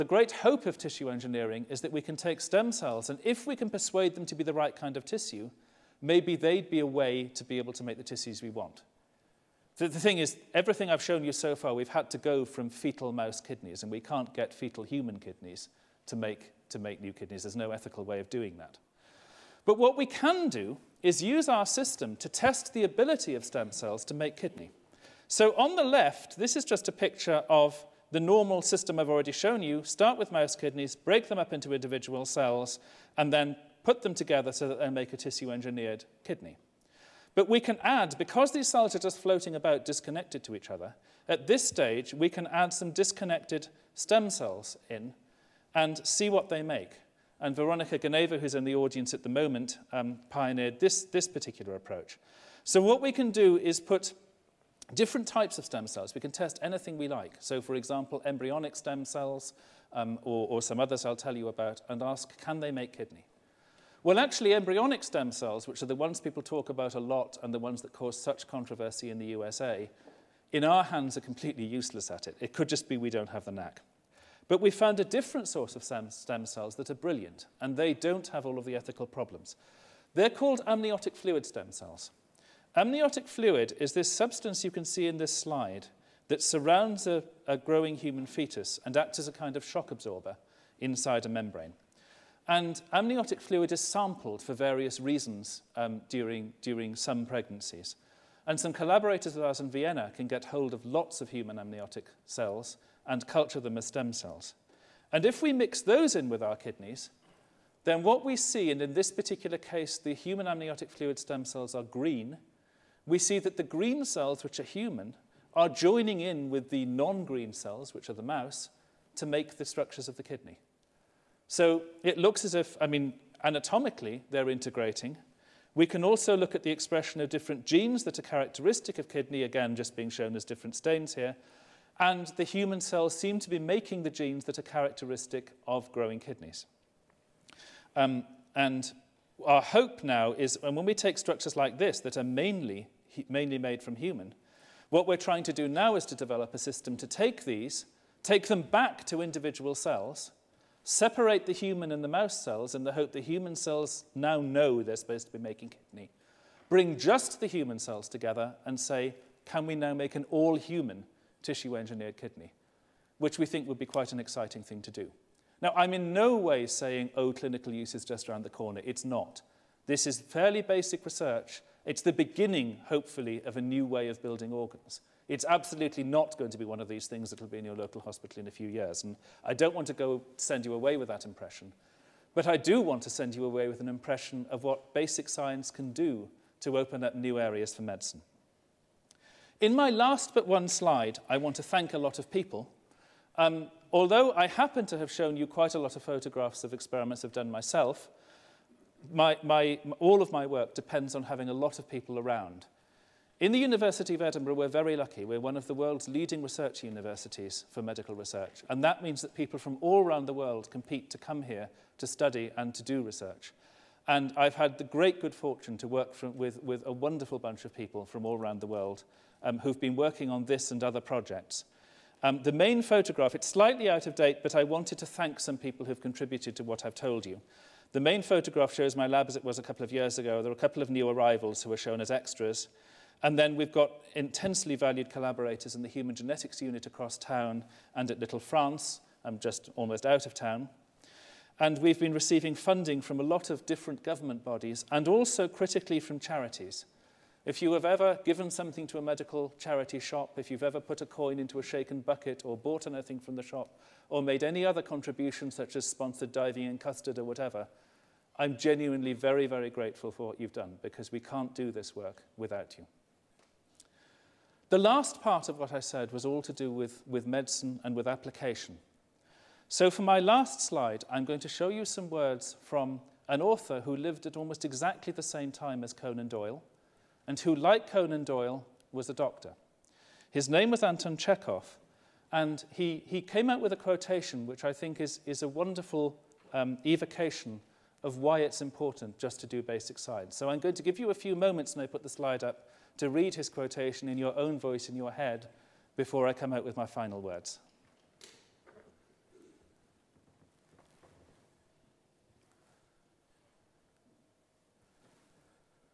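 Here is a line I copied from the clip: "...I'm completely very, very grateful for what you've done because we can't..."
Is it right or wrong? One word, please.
wrong.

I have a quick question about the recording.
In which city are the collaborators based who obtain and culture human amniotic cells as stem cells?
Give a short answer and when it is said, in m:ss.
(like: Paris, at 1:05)
Vienna, at 1:39.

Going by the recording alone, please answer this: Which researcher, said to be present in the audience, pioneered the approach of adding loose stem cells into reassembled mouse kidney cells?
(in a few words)
Veronica Ganeva.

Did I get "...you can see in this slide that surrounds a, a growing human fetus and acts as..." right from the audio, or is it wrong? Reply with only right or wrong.
right.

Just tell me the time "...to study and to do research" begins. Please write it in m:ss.
3:31.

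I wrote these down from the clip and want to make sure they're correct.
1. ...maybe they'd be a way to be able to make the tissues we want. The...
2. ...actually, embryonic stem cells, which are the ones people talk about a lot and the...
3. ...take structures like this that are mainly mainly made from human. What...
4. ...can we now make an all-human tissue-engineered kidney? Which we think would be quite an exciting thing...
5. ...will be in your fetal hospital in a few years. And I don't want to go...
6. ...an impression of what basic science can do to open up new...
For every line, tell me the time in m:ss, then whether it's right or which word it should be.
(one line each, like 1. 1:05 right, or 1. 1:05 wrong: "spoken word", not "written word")
1. 0:06 right
2. 1:04 right
3. 2:20 right
4. 2:39 right
5. 2:57 wrong: "local", not "fetal"
6. 3:03 right.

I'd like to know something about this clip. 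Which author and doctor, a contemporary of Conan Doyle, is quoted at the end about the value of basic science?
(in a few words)
Anton Chekhov.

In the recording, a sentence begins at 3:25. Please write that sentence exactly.
We're one of the world's leading research universities for medical research.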